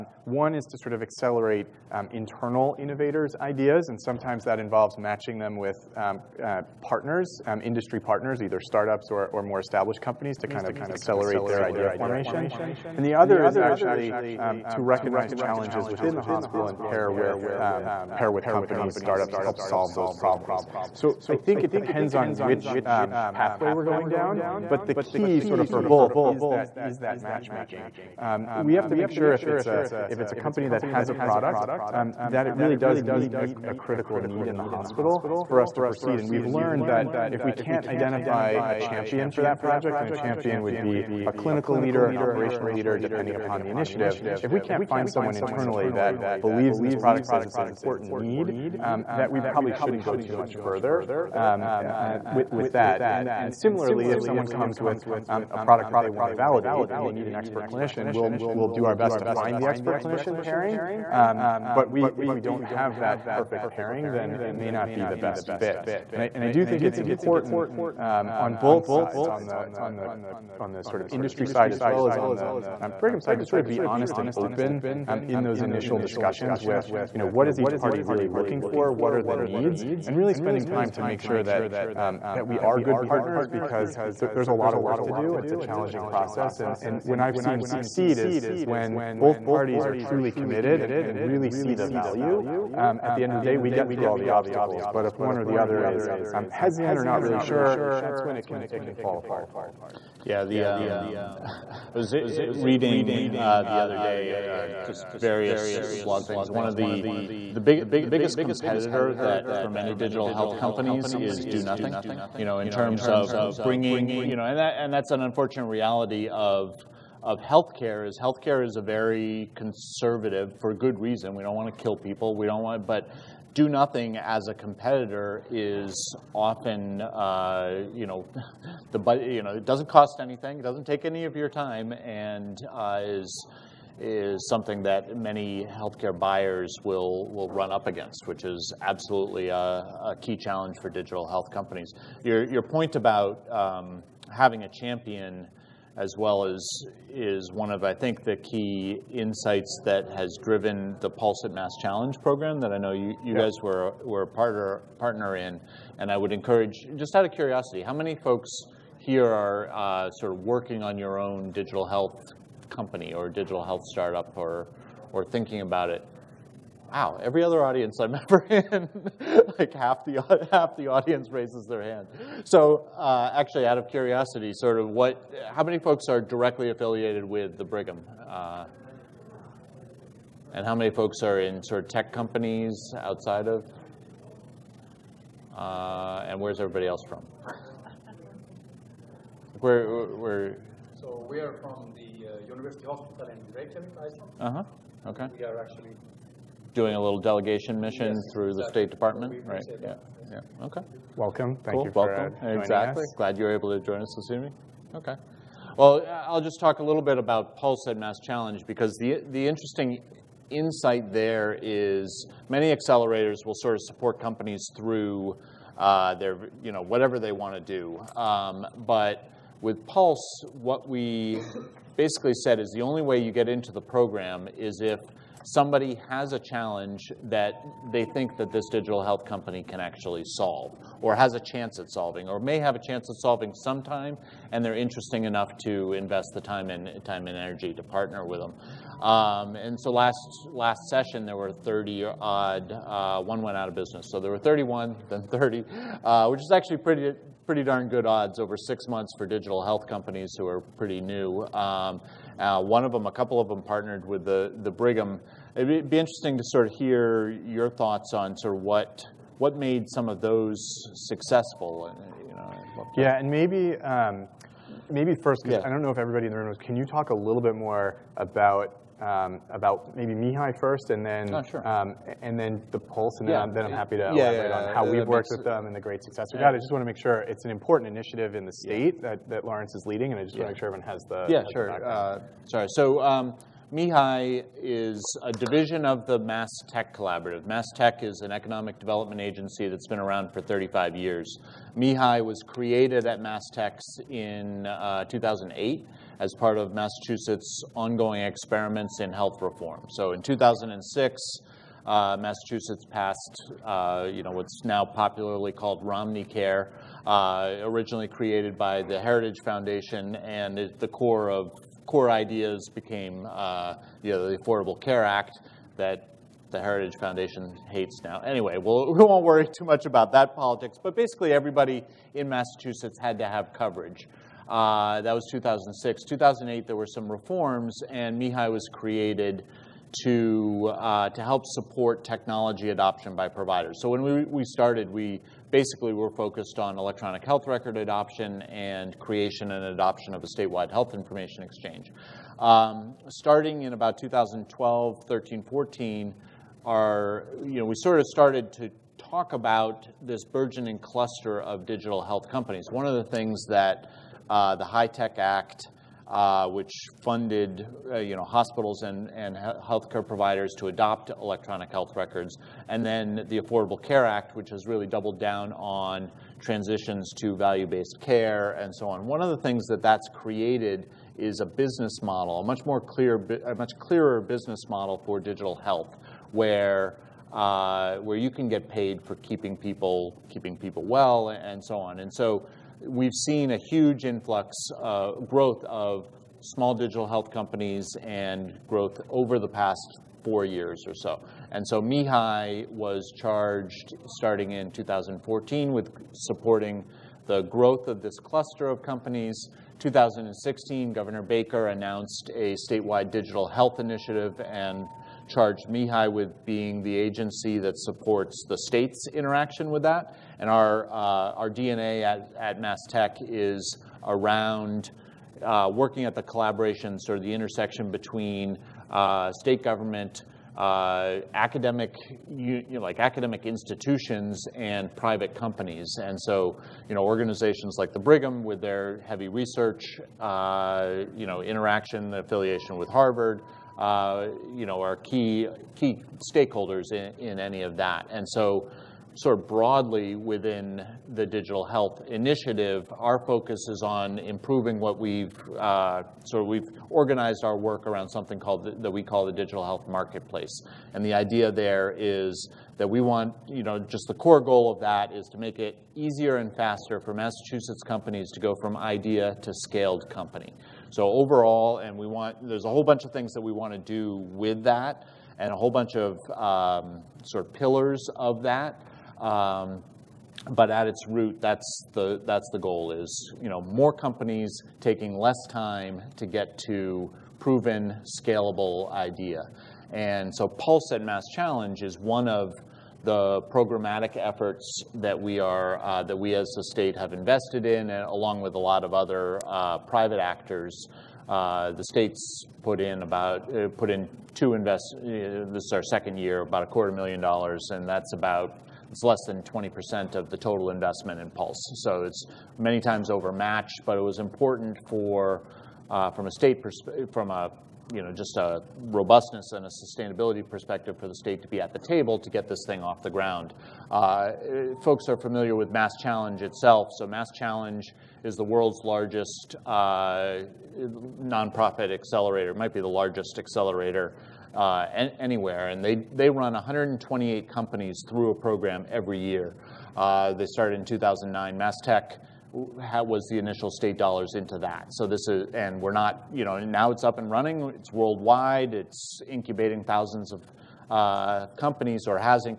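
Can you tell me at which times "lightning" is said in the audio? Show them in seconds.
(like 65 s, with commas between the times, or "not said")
not said.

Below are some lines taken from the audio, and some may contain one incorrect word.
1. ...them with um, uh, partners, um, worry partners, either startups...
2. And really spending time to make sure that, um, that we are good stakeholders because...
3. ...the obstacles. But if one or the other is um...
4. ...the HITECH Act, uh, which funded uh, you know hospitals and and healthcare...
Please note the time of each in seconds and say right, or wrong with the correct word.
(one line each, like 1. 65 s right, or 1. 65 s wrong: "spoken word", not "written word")
1. 5 s wrong: "industry", not "worry"
2. 80 s wrong: "partners", not "stakeholders"
3. 94 s right
4. 354 s right.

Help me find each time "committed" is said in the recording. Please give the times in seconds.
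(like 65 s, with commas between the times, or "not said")
90 s.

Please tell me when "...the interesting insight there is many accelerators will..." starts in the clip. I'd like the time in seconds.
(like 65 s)
209 s.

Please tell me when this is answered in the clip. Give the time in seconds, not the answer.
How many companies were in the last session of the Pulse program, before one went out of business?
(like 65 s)
244 s.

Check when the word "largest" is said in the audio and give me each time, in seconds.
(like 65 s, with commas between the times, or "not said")
518 s, 522 s.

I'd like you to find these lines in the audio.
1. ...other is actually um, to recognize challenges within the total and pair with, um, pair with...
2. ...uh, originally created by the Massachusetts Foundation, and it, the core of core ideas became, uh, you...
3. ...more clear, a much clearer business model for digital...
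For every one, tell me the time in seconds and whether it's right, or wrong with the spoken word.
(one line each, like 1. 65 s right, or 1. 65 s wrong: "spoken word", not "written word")
1. 13 s wrong: "hospital", not "total"
2. 307 s wrong: "Heritage", not "Massachusetts"
3. 372 s right.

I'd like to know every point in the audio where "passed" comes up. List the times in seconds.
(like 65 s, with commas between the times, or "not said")
302 s.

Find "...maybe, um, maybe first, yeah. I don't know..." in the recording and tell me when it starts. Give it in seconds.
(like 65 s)
263 s.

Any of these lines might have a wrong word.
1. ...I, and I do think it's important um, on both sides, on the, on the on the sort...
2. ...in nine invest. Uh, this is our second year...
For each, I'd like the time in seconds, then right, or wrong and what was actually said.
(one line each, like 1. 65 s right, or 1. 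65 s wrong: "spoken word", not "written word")
1. 66 s right
2. 493 s wrong: "two", not "nine".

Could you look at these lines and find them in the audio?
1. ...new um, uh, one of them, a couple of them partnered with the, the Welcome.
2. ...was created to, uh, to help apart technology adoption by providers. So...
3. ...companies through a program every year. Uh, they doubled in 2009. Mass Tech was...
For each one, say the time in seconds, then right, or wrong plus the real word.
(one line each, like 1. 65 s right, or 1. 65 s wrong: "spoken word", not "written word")
1. 251 s wrong: "Brigham", not "Welcome"
2. 328 s wrong: "support", not "apart"
3. 527 s wrong: "started", not "doubled".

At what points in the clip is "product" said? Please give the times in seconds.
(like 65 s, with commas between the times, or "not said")
31 s, 46 s, 55 s.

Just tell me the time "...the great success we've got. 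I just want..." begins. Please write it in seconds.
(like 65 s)
275 s.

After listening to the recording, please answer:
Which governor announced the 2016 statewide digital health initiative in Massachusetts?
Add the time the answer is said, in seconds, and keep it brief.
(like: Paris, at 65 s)
Governor Baker, at 400 s.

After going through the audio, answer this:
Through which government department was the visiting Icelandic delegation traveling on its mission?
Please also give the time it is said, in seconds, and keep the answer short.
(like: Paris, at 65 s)
State Department, at 198 s.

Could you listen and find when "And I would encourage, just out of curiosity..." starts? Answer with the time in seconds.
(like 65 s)
155 s.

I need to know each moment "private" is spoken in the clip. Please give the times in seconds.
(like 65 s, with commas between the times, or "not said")
424 s, 489 s.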